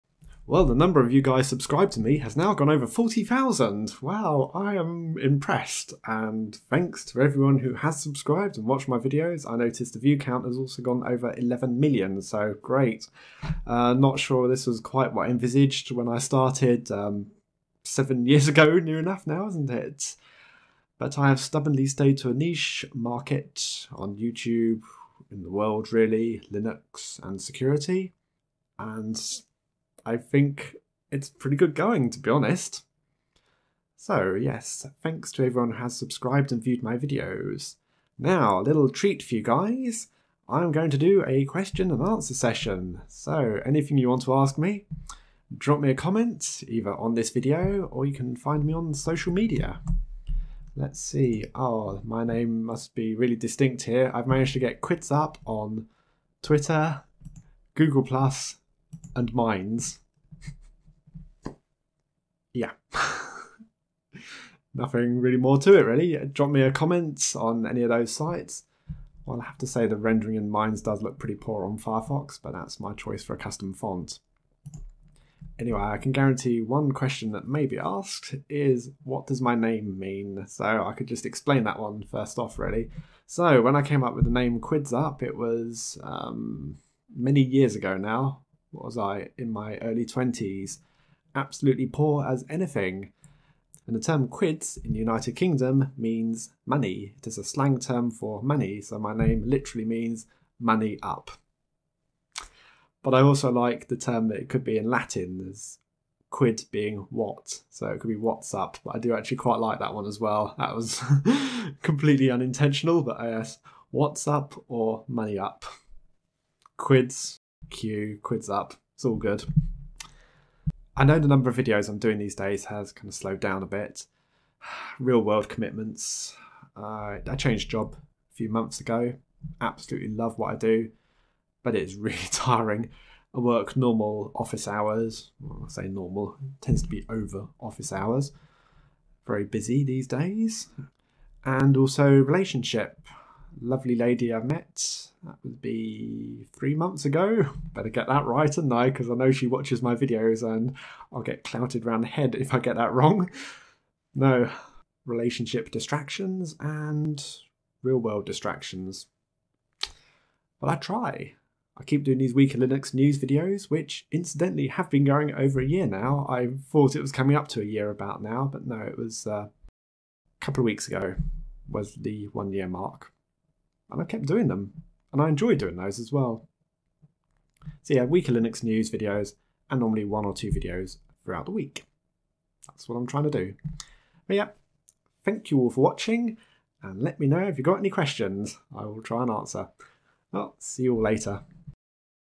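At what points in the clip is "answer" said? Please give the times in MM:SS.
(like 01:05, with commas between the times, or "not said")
00:42, 03:09.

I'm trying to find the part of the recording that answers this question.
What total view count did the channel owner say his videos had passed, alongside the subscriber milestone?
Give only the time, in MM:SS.
00:11.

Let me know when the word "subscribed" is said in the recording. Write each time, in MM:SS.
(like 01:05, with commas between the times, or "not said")
00:01, 00:08, 00:35.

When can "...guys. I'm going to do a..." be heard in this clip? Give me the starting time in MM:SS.
00:39.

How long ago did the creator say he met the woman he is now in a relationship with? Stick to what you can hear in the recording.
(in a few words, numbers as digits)
3 months ago.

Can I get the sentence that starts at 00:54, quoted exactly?
I've managed to get quidsup on Twitter, Google Plus, and Minds.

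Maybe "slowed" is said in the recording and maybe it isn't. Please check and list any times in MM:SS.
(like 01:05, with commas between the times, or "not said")
02:03.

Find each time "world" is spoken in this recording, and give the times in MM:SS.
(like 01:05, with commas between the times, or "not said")
00:25, 02:05, 02:37.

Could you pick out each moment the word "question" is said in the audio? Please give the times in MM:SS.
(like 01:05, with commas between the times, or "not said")
00:41, 01:16, 03:07.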